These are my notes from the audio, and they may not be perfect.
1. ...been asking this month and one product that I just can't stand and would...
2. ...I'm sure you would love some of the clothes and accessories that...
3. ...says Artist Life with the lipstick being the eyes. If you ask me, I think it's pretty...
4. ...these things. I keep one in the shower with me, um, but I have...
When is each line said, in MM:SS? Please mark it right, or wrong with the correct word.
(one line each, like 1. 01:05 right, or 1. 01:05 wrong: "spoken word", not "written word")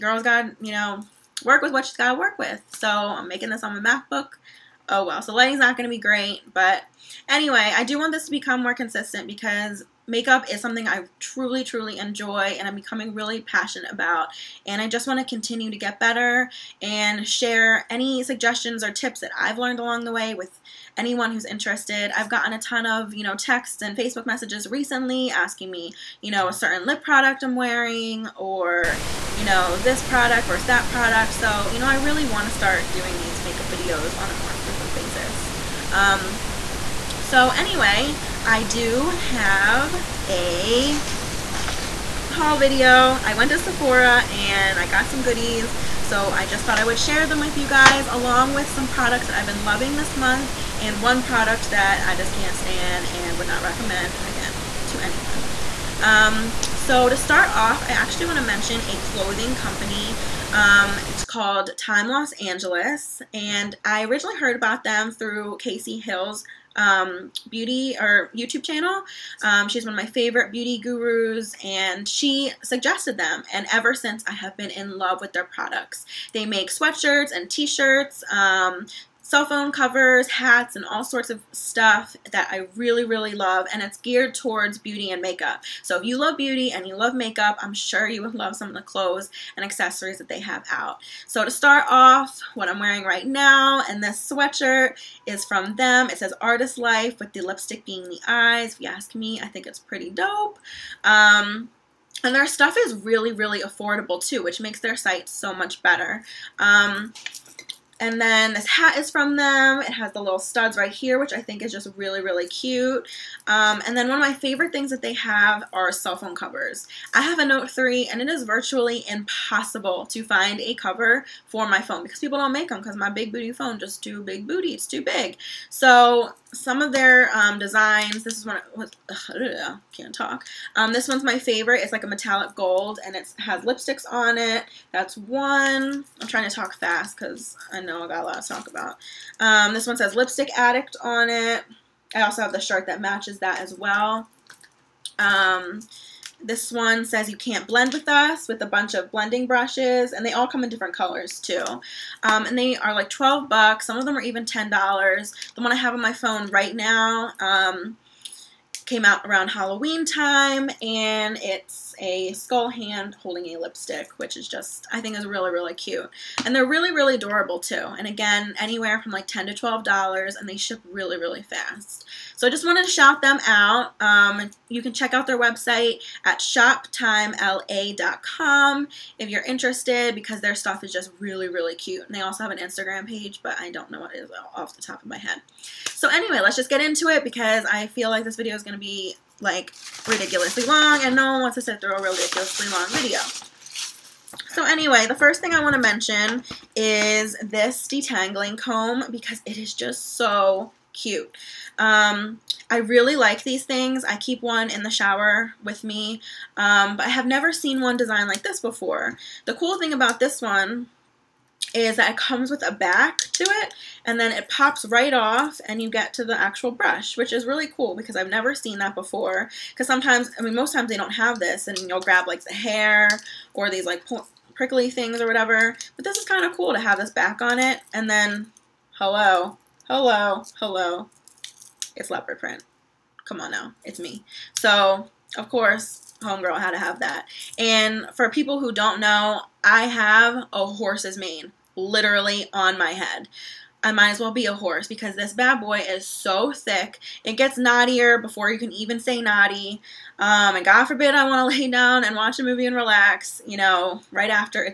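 1. 00:49 wrong: "loving", not "asking"
2. 01:27 right
3. 01:36 right
4. 03:23 right.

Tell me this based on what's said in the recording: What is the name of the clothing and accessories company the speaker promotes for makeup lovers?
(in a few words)
Time Los Angeles.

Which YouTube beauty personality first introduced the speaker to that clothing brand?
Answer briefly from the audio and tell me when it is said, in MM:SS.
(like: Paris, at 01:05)
Casey Hill, at 01:05.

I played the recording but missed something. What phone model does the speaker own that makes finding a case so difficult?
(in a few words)
Note 3.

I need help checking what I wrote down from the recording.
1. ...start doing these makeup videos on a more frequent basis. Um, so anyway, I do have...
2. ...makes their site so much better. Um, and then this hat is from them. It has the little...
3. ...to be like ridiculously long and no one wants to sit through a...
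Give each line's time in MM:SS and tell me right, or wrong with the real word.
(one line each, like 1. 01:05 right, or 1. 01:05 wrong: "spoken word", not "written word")
1. 00:32 right
2. 01:44 right
3. 03:08 right.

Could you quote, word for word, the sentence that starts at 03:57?
And for people who don't know, I have a horse's mane literally on my head.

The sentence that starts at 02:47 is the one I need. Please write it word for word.
And again, anywhere from like 10 to $12 and they ship really, really fast.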